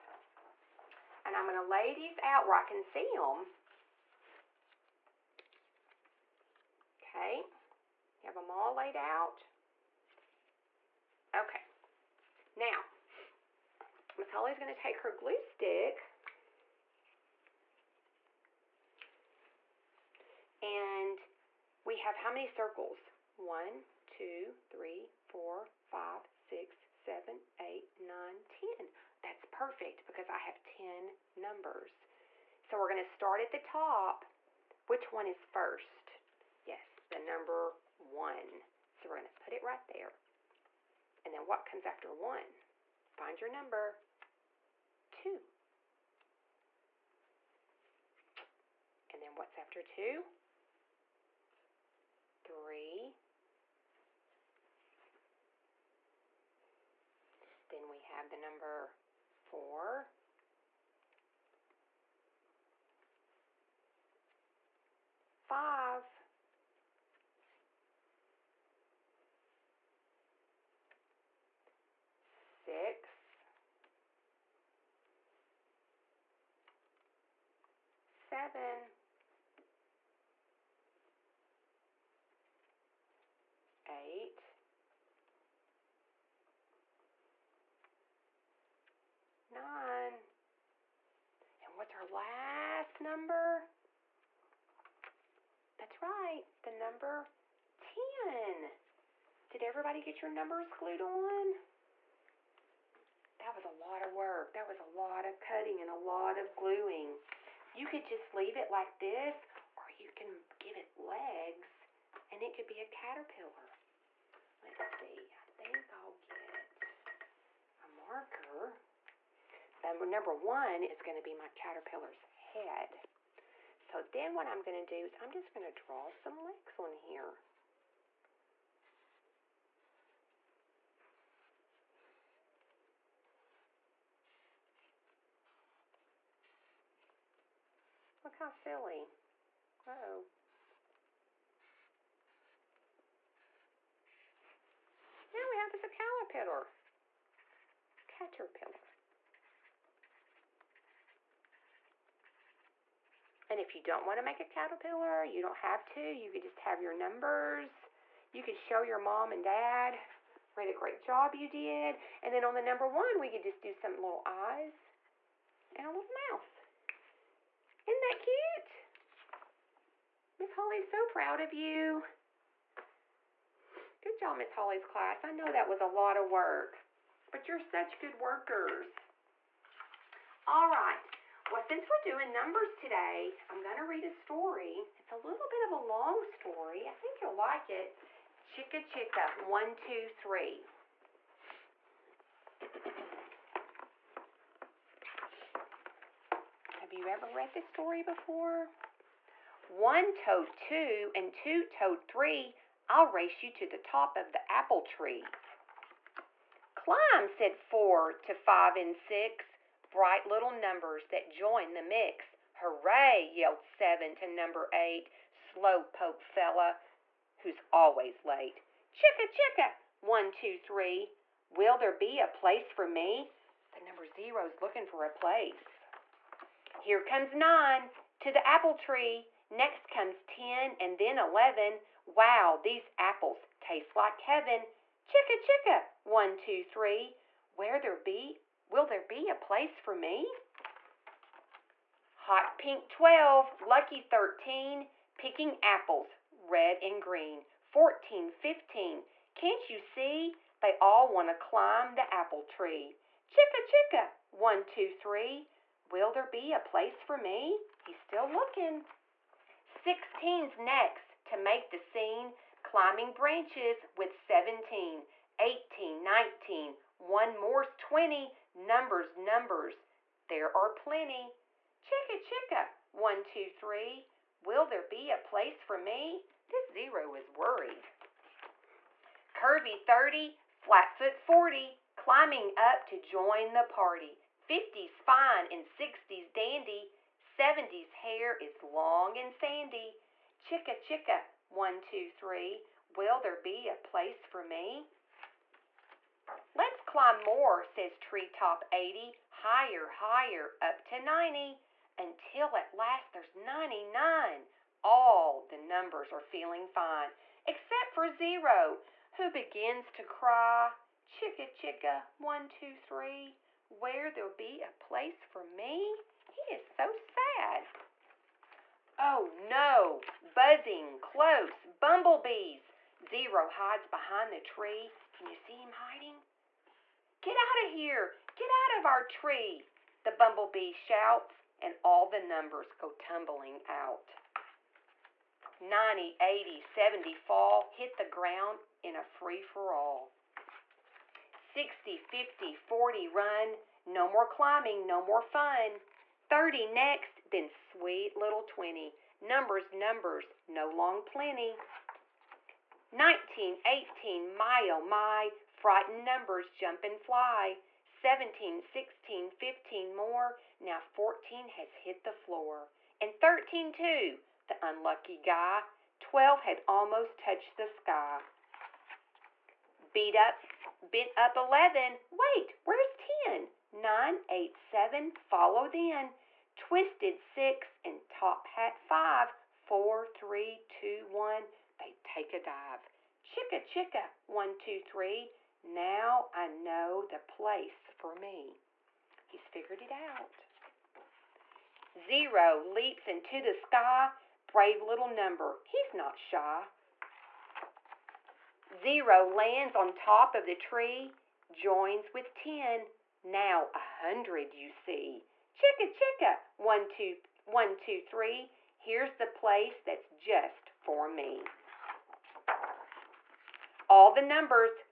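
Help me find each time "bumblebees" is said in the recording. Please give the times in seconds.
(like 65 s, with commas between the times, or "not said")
321 s, 330 s.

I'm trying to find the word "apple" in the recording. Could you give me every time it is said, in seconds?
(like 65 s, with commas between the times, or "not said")
204 s, 228 s, 232 s, 245 s, 252 s.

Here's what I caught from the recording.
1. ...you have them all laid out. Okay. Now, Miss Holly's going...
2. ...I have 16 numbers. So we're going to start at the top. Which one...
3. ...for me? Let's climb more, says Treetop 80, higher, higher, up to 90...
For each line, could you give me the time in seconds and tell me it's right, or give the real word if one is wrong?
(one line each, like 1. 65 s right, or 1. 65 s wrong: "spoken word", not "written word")
1. 8 s right
2. 30 s wrong: "10", not "16"
3. 294 s right.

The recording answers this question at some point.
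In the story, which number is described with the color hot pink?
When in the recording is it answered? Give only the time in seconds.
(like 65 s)
242 s.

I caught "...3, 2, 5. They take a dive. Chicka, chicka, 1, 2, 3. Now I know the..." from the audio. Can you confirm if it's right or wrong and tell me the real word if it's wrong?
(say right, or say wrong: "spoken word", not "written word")
wrong: "1", not "5".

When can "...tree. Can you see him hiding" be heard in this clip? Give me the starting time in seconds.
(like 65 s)
324 s.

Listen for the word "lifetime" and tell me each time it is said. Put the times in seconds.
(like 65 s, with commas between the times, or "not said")
not said.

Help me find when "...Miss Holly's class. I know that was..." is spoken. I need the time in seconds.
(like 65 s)
174 s.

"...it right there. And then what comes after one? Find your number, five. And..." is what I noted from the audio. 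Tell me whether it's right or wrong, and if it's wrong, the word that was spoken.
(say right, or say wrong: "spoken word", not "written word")
wrong: "two", not "five".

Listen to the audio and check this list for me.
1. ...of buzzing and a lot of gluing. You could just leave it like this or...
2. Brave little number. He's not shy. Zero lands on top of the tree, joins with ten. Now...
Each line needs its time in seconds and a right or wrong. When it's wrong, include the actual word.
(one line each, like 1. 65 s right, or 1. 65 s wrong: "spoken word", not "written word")
1. 105 s wrong: "cutting", not "buzzing"
2. 394 s right.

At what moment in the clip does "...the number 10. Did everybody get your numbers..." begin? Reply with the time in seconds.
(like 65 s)
96 s.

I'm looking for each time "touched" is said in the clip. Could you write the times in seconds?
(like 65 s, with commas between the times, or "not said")
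367 s.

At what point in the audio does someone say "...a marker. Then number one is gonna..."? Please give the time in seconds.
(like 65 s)
117 s.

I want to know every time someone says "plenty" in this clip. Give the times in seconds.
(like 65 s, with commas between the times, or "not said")
270 s, 351 s.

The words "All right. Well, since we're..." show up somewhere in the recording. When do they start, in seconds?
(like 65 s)
180 s.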